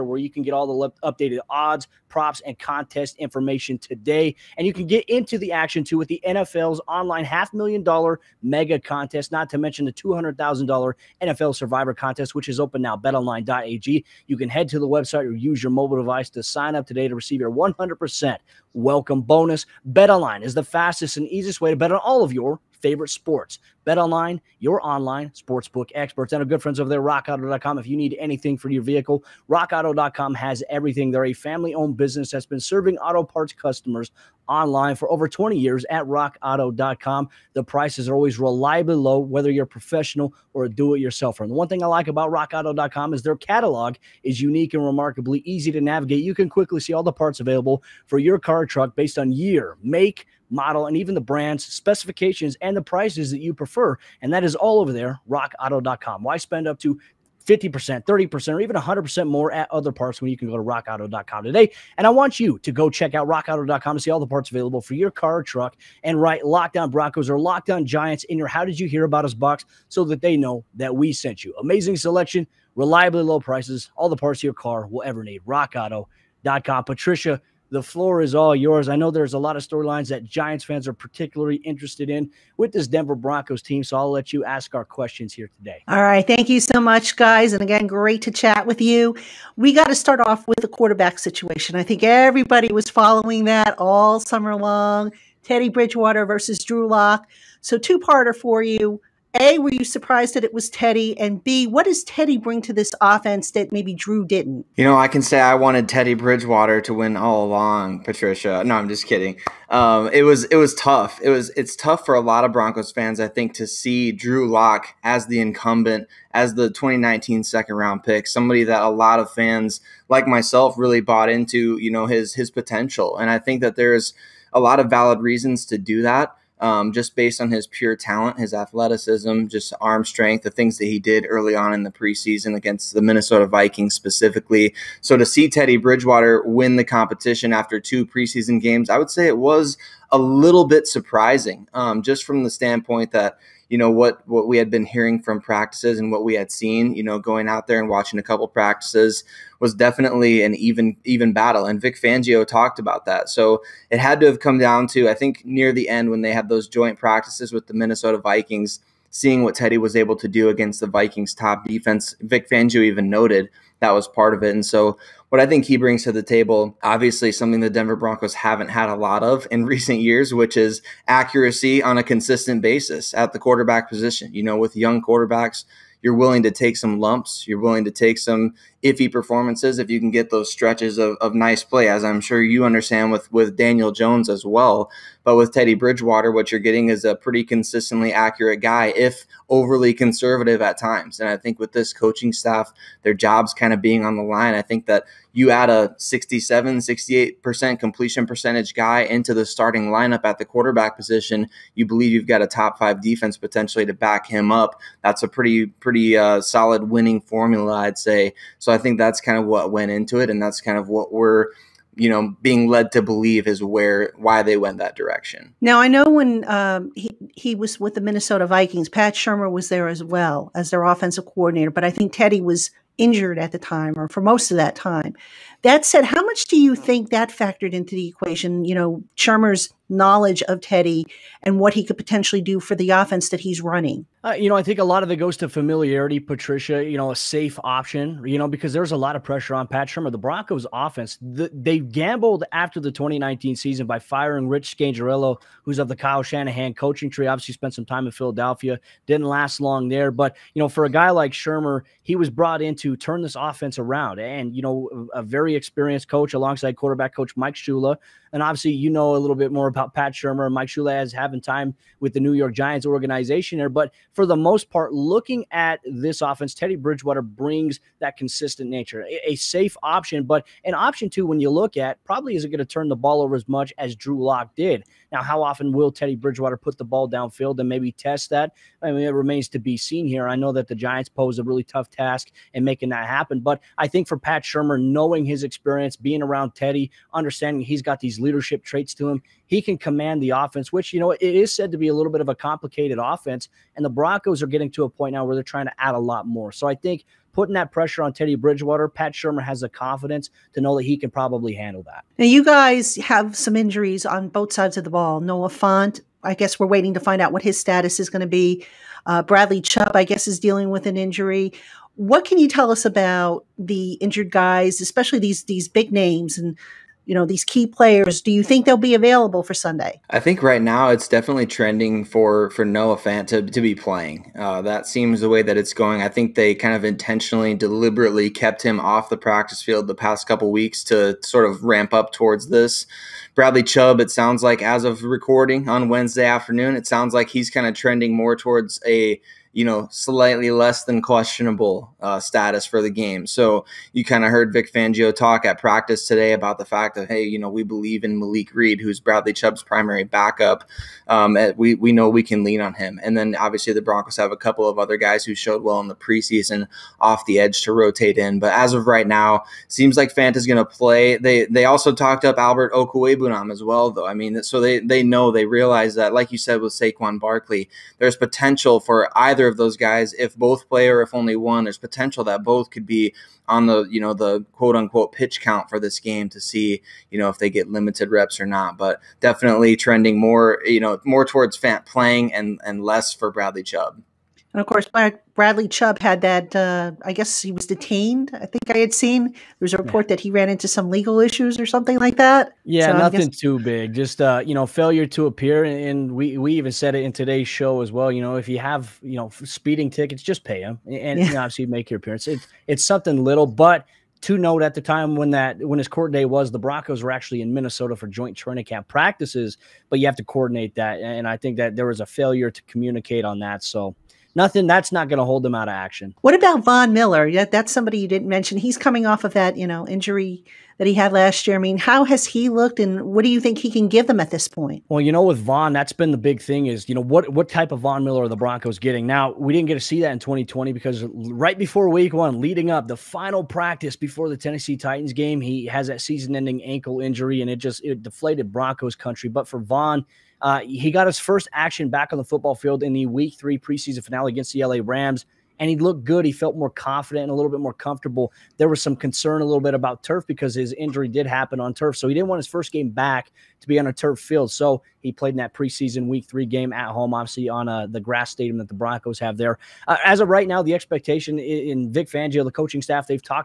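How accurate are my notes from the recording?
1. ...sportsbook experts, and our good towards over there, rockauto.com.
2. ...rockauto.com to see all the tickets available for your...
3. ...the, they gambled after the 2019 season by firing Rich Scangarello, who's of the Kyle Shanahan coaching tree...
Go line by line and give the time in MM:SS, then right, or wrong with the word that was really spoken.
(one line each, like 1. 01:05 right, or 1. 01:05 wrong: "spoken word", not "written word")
1. 00:25 wrong: "friends", not "towards"
2. 01:03 wrong: "parts", not "tickets"
3. 04:01 right.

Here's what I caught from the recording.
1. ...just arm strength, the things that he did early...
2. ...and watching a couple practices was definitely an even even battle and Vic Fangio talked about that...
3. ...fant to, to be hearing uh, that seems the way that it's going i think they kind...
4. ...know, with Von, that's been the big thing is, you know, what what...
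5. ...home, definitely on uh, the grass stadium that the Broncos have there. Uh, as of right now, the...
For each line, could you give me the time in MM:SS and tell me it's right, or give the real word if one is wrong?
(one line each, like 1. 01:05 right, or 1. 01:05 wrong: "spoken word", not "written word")
1. 02:09 right
2. 02:27 right
3. 05:22 wrong: "playing", not "hearing"
4. 07:05 right
5. 07:36 wrong: "obviously", not "definitely".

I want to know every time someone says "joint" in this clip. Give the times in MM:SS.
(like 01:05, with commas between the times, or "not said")
02:36, 06:48.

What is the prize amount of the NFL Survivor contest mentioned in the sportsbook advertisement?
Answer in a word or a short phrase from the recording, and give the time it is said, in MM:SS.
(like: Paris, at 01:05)
$200,000, at 00:09.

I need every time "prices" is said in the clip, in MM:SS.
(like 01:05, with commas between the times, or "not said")
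00:37, 00:52, 01:13.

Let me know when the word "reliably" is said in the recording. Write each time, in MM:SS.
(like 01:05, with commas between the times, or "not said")
00:38, 01:12.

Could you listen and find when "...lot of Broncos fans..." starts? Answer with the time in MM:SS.
01:52.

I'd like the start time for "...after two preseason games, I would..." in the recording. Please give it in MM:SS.
02:17.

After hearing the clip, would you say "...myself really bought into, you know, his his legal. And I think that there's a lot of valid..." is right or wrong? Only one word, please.
wrong.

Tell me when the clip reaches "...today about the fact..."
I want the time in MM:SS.
05:46.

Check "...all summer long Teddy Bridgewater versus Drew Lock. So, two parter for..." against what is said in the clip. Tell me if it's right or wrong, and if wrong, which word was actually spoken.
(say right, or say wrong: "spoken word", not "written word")
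right.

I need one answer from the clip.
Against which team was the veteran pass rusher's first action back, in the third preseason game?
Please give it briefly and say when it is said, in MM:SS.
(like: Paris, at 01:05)
LA Rams, at 07:24.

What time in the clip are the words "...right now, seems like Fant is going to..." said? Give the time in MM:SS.
05:58.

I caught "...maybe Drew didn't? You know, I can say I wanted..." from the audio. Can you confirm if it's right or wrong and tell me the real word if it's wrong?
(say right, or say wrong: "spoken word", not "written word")
right.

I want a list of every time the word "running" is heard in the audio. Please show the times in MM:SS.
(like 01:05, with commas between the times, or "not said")
03:53.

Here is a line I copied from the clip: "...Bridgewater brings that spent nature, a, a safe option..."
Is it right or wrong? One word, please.
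wrong.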